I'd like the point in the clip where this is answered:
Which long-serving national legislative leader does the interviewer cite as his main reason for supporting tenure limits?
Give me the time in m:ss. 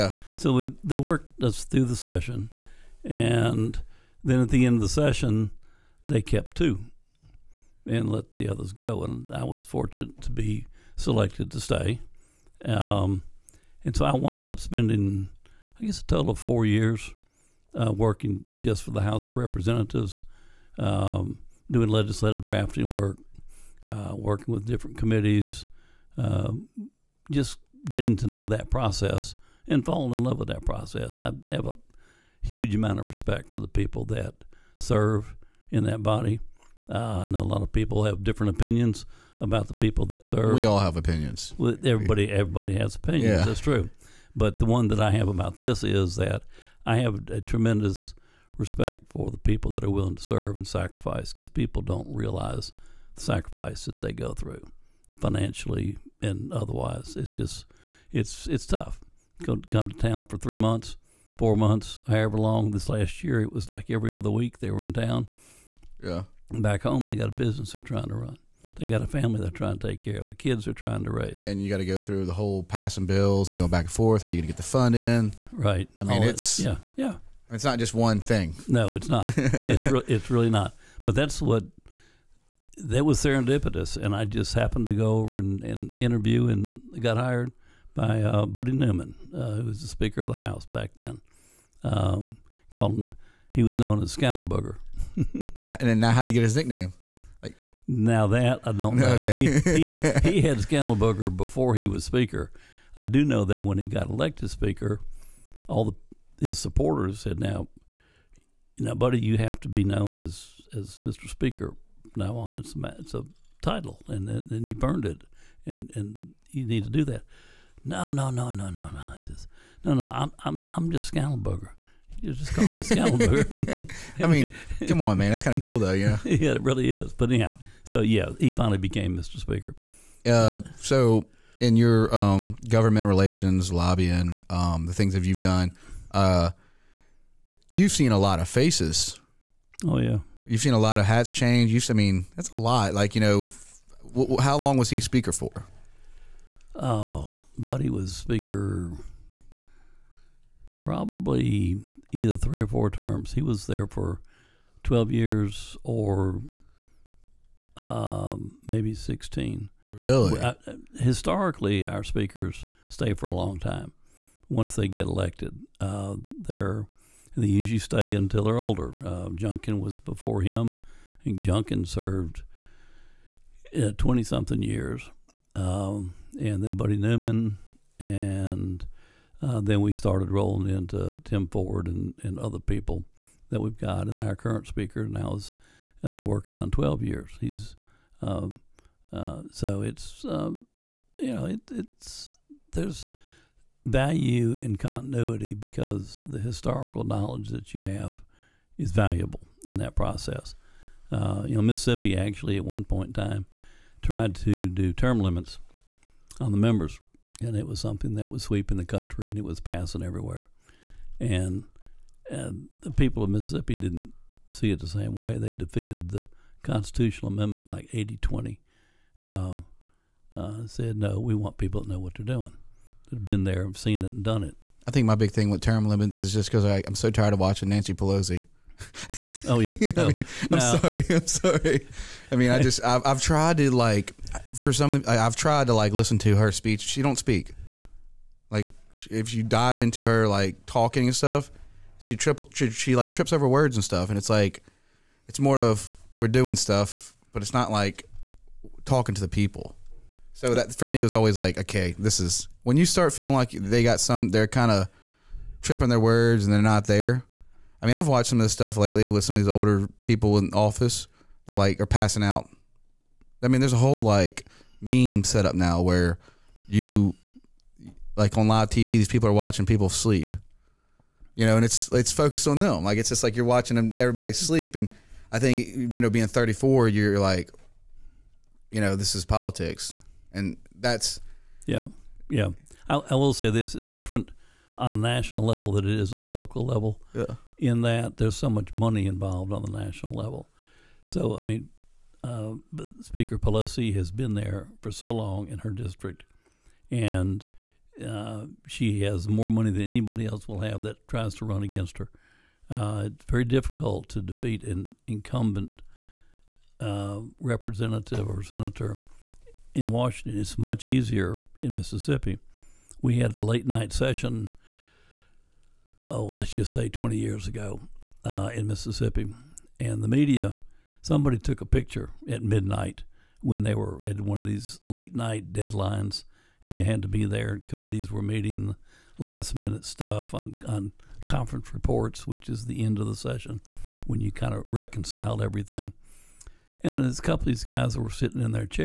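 3:47.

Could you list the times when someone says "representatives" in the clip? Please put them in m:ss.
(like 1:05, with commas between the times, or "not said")
0:19, 5:07.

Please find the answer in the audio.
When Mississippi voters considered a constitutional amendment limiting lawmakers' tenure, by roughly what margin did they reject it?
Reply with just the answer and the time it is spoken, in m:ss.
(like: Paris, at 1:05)
80-20, at 3:37.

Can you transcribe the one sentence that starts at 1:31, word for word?
Um, called him, he was known as Scandalburger.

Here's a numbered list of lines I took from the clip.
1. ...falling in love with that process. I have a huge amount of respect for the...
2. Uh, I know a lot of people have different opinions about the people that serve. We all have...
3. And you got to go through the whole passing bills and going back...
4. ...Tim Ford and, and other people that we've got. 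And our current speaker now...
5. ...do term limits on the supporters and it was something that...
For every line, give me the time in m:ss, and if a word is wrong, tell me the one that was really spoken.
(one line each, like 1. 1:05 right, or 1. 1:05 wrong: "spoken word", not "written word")
1. 0:29 right
2. 0:36 right
3. 1:11 right
4. 3:01 right
5. 3:24 wrong: "members", not "supporters".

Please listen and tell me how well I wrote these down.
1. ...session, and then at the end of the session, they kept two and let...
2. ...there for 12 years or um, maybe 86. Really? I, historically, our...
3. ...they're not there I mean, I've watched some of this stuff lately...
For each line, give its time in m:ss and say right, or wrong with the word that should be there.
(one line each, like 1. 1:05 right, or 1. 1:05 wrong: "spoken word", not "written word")
1. 0:01 right
2. 2:33 wrong: "16", not "86"
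3. 4:16 right.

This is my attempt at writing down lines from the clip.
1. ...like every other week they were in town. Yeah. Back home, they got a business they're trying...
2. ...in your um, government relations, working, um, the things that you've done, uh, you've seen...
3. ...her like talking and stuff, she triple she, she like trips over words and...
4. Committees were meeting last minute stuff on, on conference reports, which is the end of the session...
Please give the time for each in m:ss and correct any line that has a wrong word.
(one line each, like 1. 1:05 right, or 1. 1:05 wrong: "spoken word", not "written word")
1. 1:03 right
2. 2:11 wrong: "lobbying", not "working"
3. 4:00 right
4. 5:27 right.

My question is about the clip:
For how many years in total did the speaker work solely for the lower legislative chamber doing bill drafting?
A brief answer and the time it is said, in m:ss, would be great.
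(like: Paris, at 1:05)
4, at 0:16.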